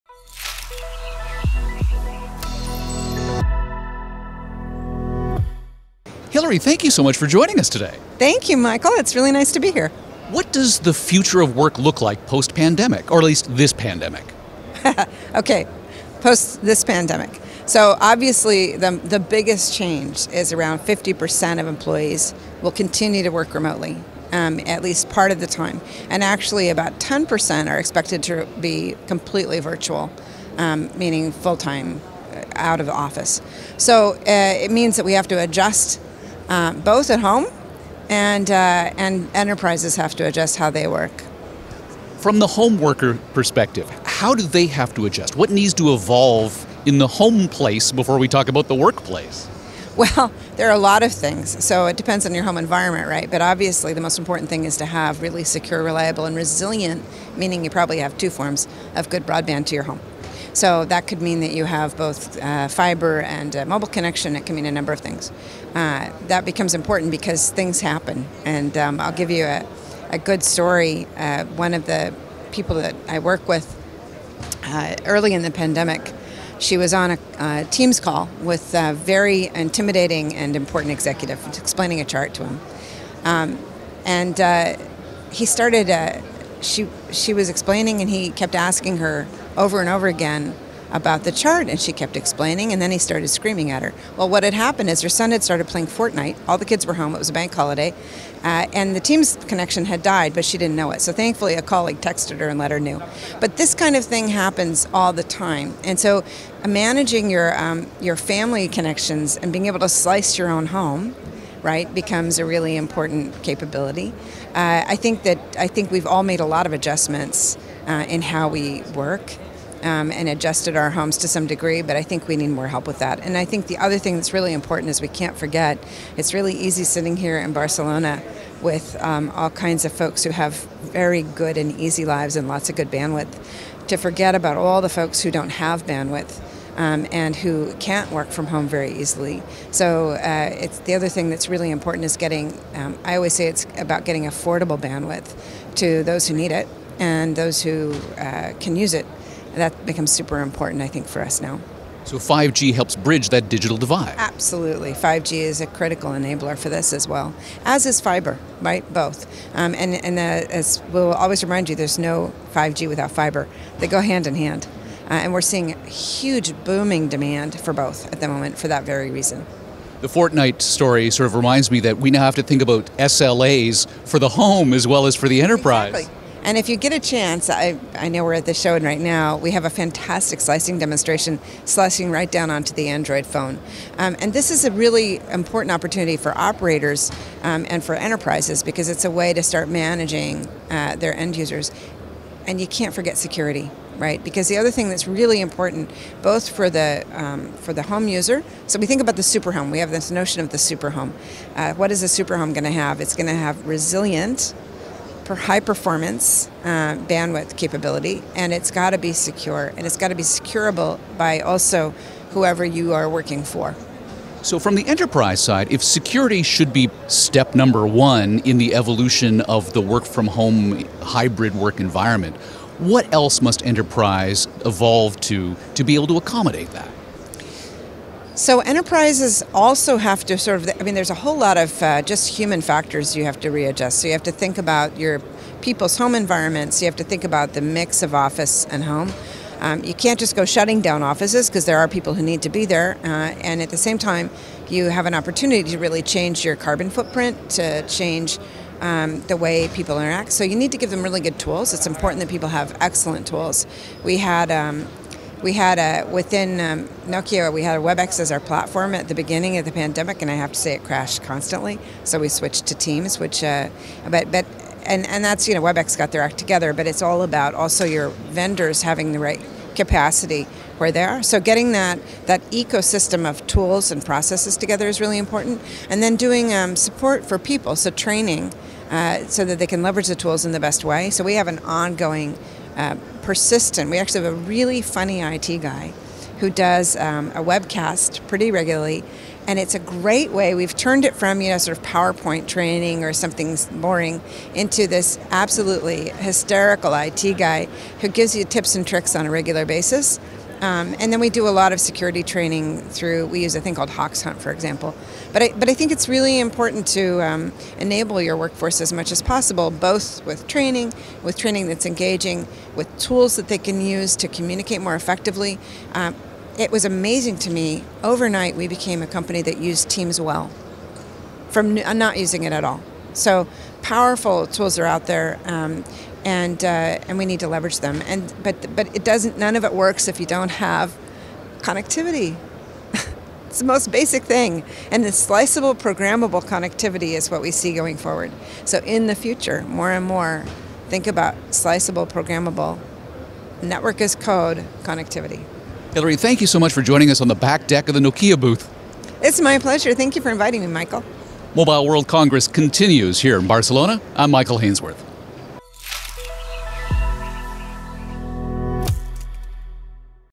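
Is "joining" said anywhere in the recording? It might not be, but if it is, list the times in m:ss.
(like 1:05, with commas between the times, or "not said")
0:07, 5:46.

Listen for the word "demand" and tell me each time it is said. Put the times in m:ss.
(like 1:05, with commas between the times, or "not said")
2:47.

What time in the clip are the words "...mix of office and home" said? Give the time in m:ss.
3:57.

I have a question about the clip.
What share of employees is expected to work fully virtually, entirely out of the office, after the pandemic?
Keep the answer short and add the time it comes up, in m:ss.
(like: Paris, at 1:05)
10%, at 0:26.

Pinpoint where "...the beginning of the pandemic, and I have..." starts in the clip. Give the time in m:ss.
4:19.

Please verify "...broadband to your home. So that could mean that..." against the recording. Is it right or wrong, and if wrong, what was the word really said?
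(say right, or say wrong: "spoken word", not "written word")
right.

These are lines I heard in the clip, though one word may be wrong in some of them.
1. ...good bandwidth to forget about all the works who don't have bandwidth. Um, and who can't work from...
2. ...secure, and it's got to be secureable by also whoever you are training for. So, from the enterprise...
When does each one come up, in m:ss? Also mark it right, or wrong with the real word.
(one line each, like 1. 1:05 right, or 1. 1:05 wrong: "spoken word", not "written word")
1. 2:12 wrong: "folks", not "works"
2. 3:29 wrong: "working", not "training".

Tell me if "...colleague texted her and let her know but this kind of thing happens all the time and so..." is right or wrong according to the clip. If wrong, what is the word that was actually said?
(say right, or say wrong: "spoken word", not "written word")
right.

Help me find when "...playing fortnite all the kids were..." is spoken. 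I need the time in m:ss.
1:35.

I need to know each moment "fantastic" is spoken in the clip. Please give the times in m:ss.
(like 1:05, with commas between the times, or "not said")
2:59.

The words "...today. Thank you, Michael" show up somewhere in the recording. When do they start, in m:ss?
0:07.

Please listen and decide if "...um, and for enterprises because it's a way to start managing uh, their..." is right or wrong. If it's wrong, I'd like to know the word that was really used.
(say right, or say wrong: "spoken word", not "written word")
right.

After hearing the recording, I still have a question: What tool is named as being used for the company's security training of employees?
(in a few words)
Hoxhunt.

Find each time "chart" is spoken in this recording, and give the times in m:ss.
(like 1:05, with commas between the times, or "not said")
1:22, 1:31.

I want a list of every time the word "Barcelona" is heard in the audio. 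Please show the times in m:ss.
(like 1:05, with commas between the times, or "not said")
2:07, 5:53.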